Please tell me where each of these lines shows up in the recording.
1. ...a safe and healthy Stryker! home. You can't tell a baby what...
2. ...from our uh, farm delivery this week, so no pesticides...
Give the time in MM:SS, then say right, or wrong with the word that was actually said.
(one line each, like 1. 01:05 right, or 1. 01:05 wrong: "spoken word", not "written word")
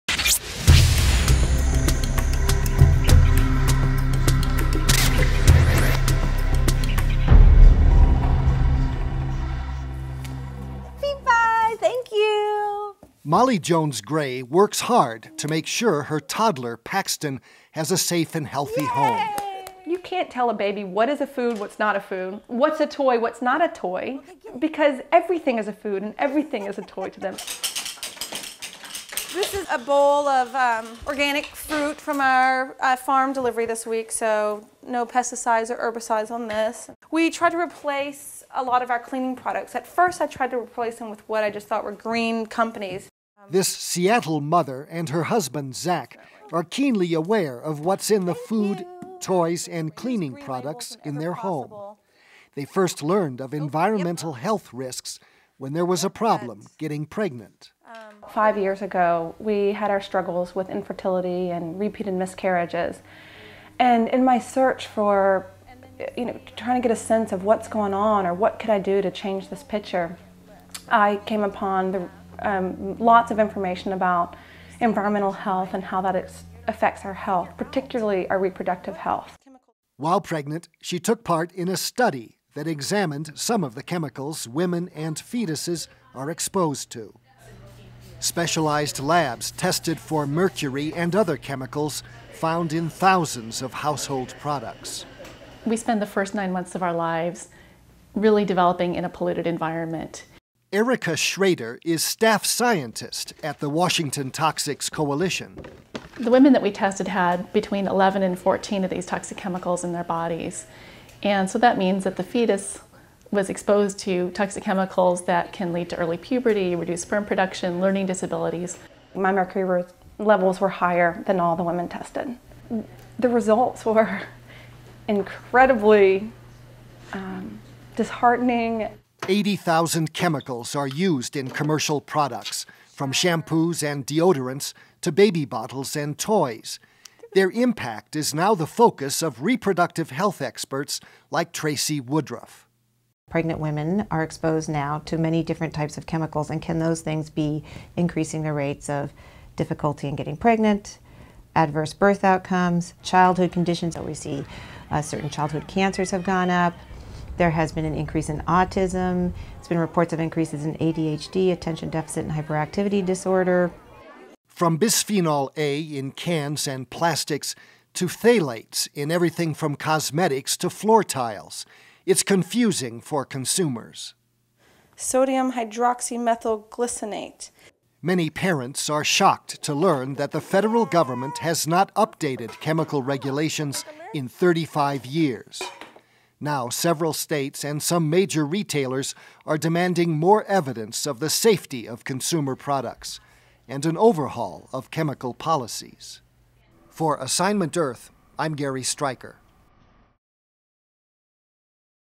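1. 00:17 wrong: "Yay", not "Stryker"
2. 00:32 right.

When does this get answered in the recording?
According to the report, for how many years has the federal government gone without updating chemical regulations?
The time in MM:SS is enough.
03:04.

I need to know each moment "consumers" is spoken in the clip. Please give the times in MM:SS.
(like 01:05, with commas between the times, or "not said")
02:53, 03:12.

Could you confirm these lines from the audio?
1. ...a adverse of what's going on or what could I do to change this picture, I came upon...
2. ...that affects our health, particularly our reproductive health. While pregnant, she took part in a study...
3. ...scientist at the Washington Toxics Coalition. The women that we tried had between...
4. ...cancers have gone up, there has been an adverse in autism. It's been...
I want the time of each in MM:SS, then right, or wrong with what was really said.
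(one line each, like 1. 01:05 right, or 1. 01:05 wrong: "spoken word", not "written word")
1. 01:06 wrong: "sense", not "adverse"
2. 01:16 right
3. 01:42 wrong: "tested", not "tried"
4. 02:35 wrong: "increase", not "adverse".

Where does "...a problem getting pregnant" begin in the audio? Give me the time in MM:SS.
00:56.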